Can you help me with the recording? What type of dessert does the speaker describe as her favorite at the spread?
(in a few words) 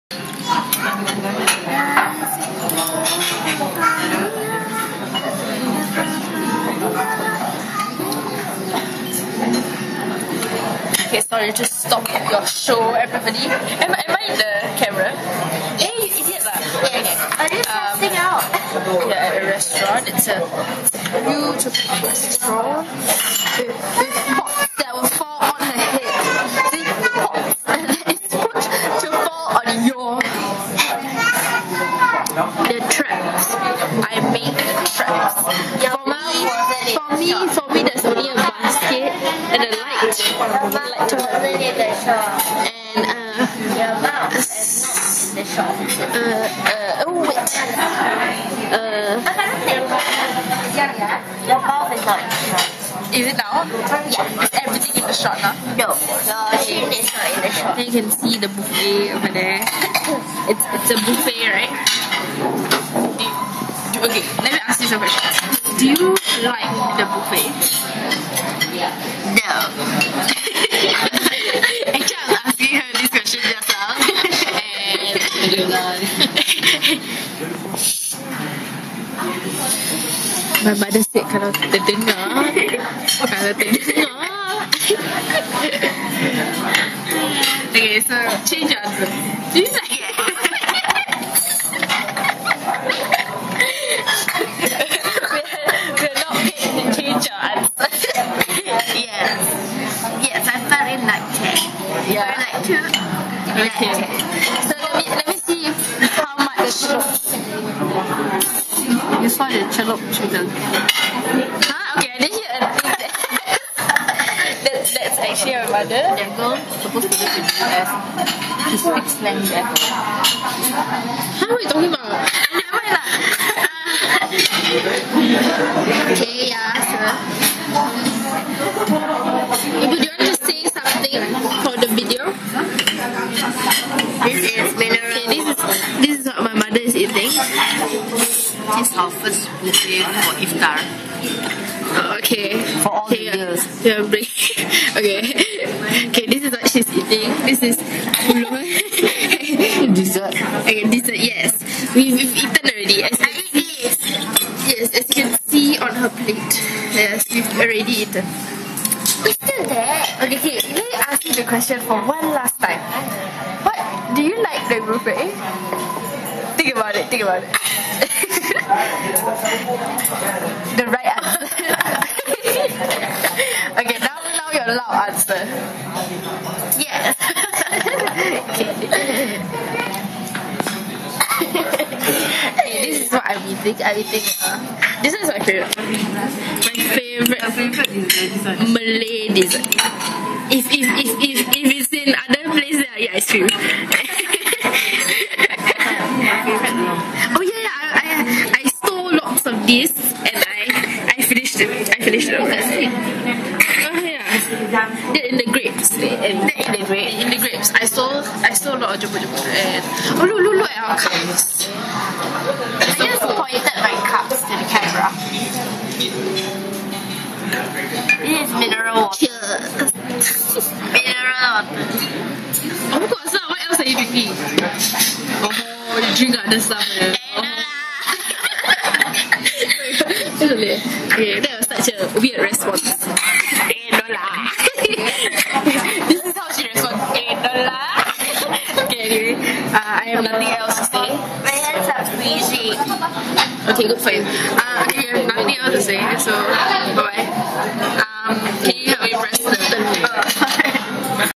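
Malay dessert.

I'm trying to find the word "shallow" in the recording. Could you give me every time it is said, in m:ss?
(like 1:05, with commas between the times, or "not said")
not said.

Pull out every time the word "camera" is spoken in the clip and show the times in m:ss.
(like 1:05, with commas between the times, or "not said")
0:14, 3:34.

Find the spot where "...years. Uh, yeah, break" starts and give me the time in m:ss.
2:23.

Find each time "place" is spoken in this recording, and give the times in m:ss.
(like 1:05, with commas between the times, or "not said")
3:12.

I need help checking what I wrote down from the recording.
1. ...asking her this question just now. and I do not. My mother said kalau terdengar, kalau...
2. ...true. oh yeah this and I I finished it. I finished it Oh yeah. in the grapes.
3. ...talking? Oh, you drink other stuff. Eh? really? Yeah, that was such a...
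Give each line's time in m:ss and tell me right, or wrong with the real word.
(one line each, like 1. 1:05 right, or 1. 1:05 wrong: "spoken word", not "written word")
1. 1:12 right
2. 3:13 right
3. 3:43 wrong: "drinking", not "talking".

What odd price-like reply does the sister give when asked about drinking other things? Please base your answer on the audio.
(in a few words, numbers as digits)
8 dollars.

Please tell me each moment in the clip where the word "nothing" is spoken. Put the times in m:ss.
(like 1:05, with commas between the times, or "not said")
4:00, 4:05.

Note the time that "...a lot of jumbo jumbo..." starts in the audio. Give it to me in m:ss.
3:28.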